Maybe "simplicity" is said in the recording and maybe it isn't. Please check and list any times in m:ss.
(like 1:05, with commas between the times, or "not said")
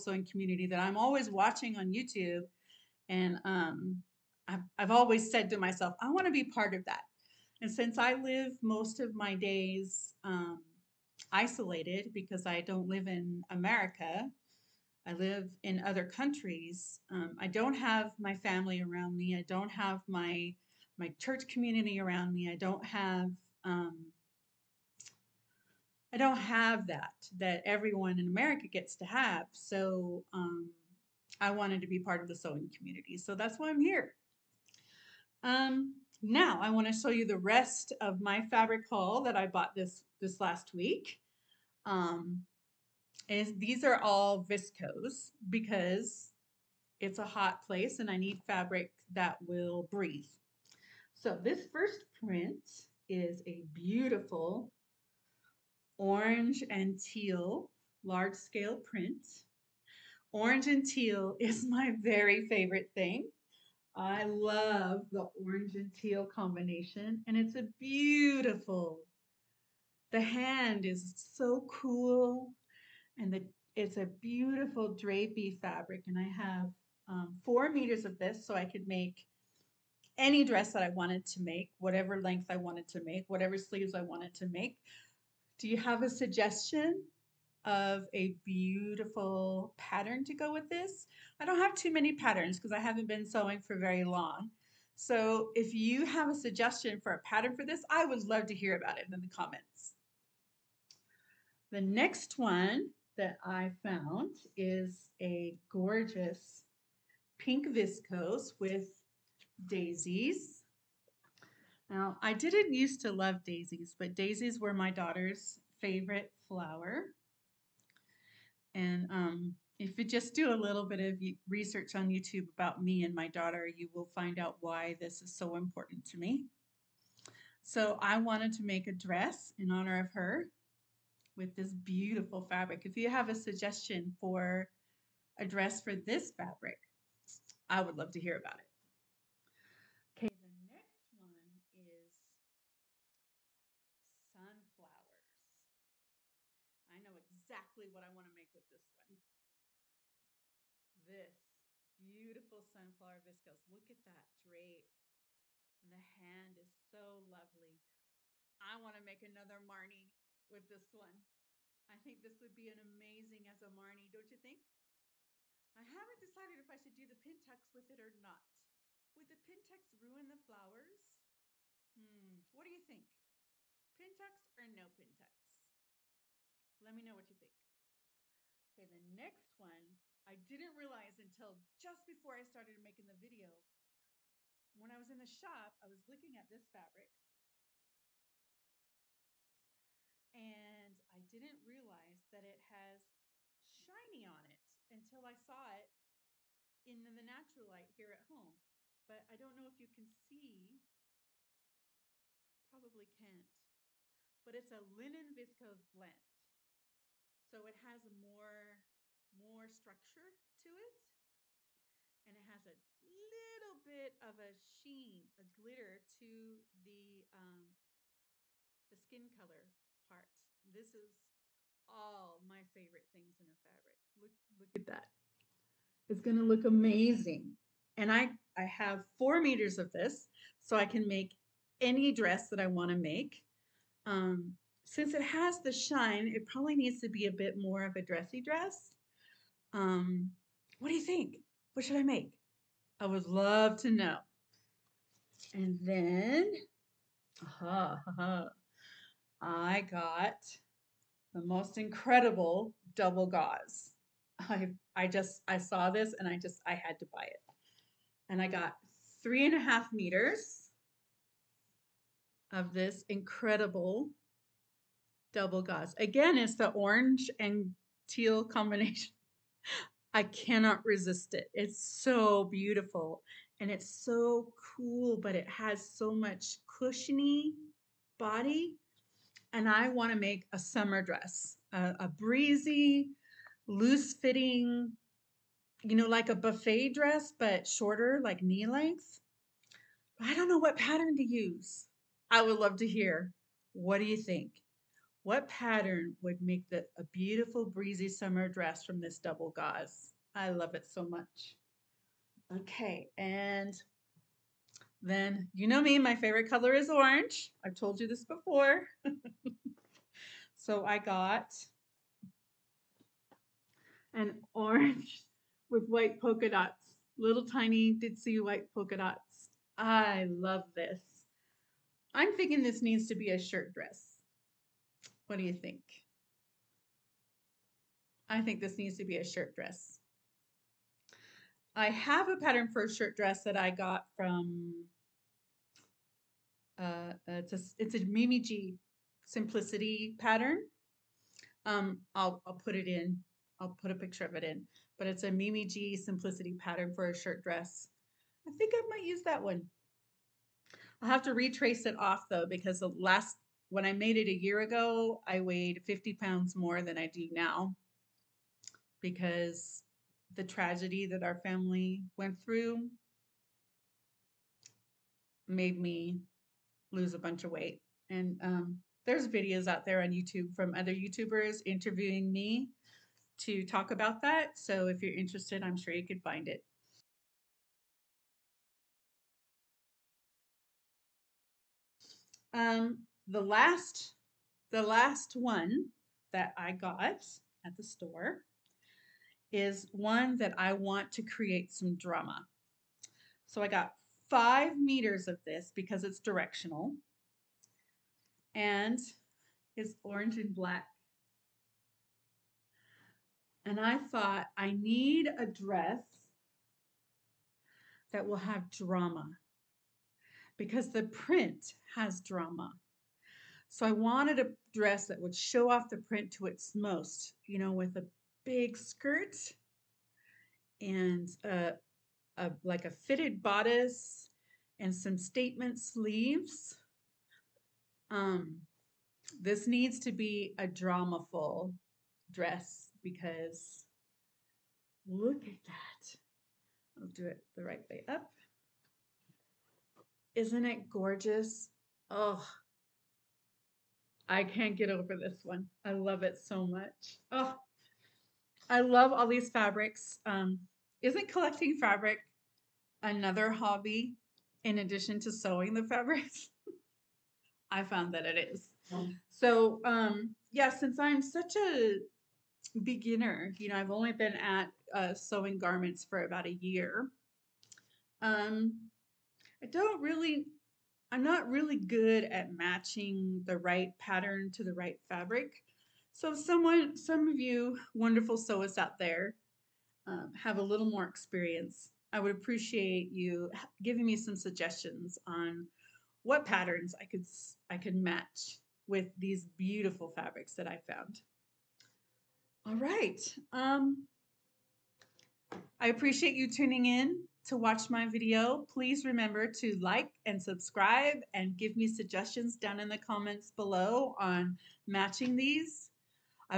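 5:39, 5:45.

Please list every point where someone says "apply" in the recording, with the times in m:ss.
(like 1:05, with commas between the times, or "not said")
not said.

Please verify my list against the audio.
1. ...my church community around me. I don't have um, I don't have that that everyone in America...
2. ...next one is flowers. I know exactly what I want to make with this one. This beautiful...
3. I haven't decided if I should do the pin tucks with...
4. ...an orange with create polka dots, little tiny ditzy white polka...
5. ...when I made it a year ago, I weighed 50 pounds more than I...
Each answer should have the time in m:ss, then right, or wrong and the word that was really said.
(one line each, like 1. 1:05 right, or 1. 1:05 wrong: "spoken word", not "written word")
1. 0:20 right
2. 2:20 wrong: "sunflowers", not "flowers"
3. 2:45 right
4. 5:14 wrong: "white", not "create"
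5. 5:53 right.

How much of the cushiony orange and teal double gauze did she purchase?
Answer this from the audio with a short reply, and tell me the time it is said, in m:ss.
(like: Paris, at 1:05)
3.5 meters, at 4:19.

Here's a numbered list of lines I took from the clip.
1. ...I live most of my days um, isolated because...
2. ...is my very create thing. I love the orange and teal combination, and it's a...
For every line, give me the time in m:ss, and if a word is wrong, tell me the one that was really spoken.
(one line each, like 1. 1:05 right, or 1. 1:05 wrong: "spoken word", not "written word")
1. 0:07 right
2. 1:01 wrong: "favorite", not "create".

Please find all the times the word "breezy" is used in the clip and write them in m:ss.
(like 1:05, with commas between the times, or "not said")
4:42, 4:57.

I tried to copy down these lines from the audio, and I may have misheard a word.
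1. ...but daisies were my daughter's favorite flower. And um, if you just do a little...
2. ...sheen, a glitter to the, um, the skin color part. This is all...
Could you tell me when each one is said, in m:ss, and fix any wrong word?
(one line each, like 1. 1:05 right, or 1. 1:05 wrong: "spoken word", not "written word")
1. 1:53 right
2. 3:34 right.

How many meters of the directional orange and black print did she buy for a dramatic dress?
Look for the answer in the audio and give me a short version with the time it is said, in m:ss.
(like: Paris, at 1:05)
5 meters, at 6:34.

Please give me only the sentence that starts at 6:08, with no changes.
And um, there's videos out there on YouTube from other YouTubers interviewing me to talk about that.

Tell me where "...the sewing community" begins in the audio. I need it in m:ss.
0:32.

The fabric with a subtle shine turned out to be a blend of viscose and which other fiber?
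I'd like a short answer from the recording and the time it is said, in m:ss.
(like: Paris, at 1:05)
Linen, at 3:24.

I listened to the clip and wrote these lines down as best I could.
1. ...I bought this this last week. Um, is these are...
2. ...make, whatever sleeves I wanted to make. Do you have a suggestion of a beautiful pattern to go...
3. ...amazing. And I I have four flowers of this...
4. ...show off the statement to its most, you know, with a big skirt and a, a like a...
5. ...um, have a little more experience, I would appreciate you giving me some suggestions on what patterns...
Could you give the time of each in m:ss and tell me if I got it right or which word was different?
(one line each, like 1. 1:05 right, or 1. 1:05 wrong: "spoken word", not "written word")
1. 0:39 right
2. 1:23 right
3. 3:46 wrong: "meters", not "flowers"
4. 6:55 wrong: "print", not "statement"
5. 8:00 right.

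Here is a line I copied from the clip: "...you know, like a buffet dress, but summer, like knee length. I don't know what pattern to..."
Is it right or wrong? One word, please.
wrong.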